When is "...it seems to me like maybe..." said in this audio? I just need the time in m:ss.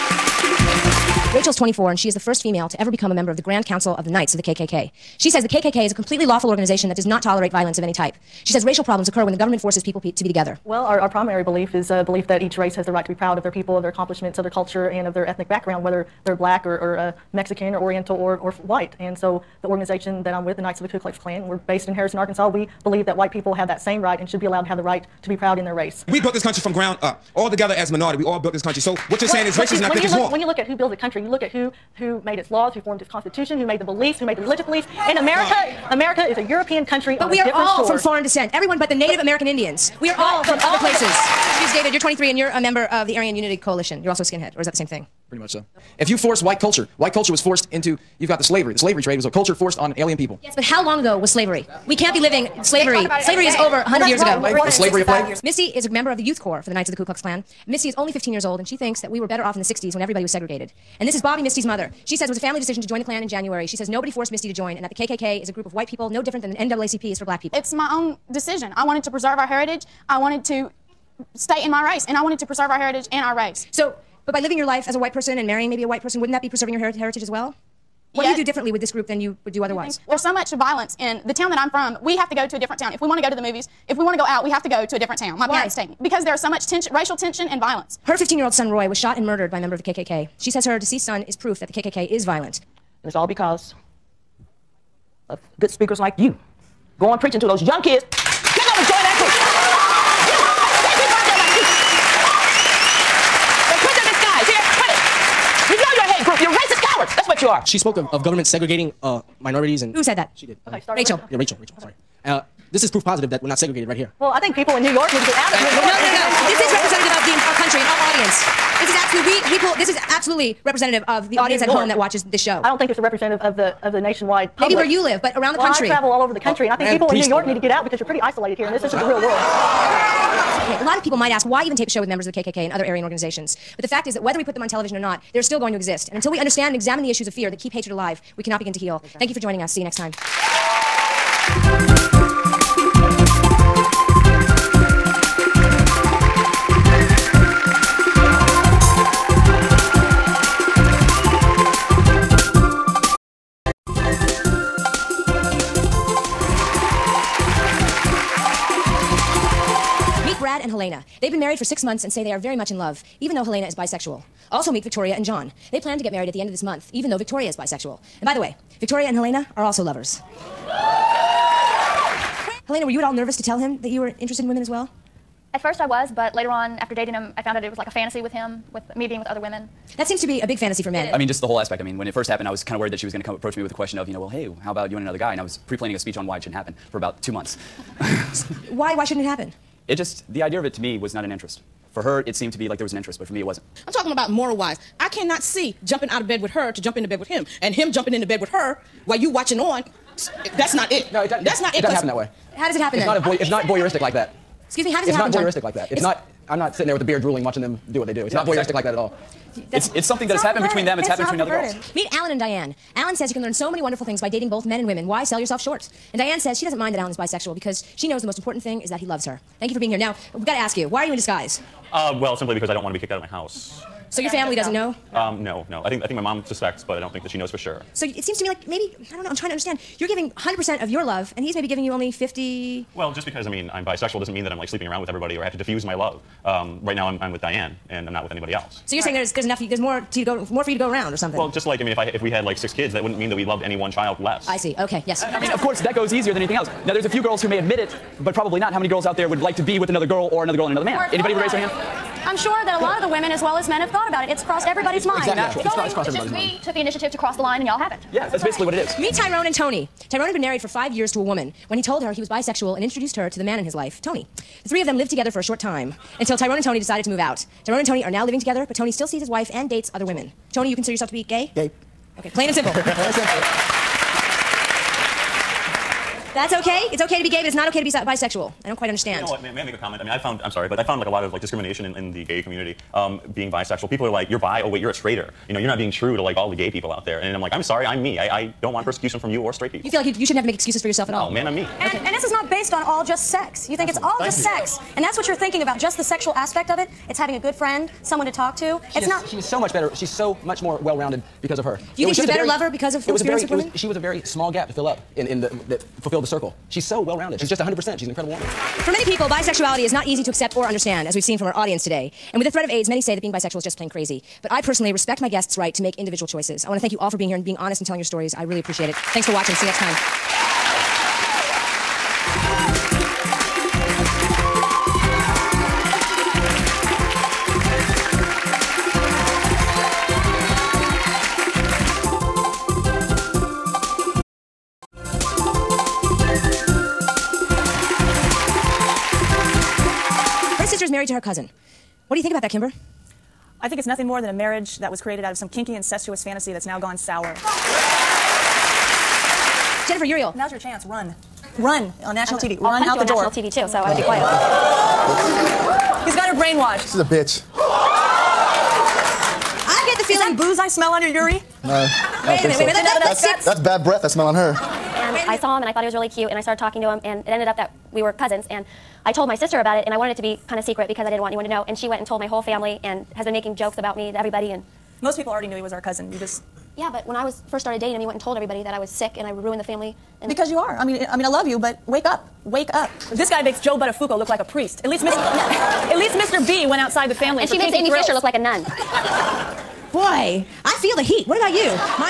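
3:48.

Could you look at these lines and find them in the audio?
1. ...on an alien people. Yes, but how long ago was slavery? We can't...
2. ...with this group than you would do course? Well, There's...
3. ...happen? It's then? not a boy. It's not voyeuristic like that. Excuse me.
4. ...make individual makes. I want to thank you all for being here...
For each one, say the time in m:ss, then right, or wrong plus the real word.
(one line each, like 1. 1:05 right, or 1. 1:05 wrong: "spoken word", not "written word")
1. 0:49 right
2. 1:18 wrong: "otherwise", not "course"
3. 3:22 right
4. 5:15 wrong: "choices", not "makes".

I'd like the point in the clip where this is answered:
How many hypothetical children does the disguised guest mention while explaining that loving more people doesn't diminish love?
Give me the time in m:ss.
4:02.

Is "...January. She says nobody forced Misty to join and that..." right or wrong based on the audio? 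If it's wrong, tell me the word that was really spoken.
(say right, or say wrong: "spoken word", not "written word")
right.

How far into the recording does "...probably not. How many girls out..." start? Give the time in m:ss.
4:08.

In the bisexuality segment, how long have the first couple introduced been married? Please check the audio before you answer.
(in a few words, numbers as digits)
six months.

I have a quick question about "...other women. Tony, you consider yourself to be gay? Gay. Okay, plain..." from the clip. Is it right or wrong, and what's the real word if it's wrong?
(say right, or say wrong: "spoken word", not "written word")
right.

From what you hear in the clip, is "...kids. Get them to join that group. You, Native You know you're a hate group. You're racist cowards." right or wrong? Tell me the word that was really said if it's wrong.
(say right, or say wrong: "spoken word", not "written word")
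wrong: "The", not "Native".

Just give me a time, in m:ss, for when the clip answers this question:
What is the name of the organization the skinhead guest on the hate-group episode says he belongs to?
0:43.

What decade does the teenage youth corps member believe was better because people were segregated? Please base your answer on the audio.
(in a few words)
the 60s.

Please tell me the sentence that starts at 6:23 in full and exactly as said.
This guy makes Joe Buttafuoco look like a priest.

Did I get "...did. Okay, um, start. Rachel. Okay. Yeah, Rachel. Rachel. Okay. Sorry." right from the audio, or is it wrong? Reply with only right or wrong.
right.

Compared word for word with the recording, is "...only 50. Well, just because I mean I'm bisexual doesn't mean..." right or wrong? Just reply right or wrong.
right.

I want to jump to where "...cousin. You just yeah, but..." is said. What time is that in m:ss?
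6:15.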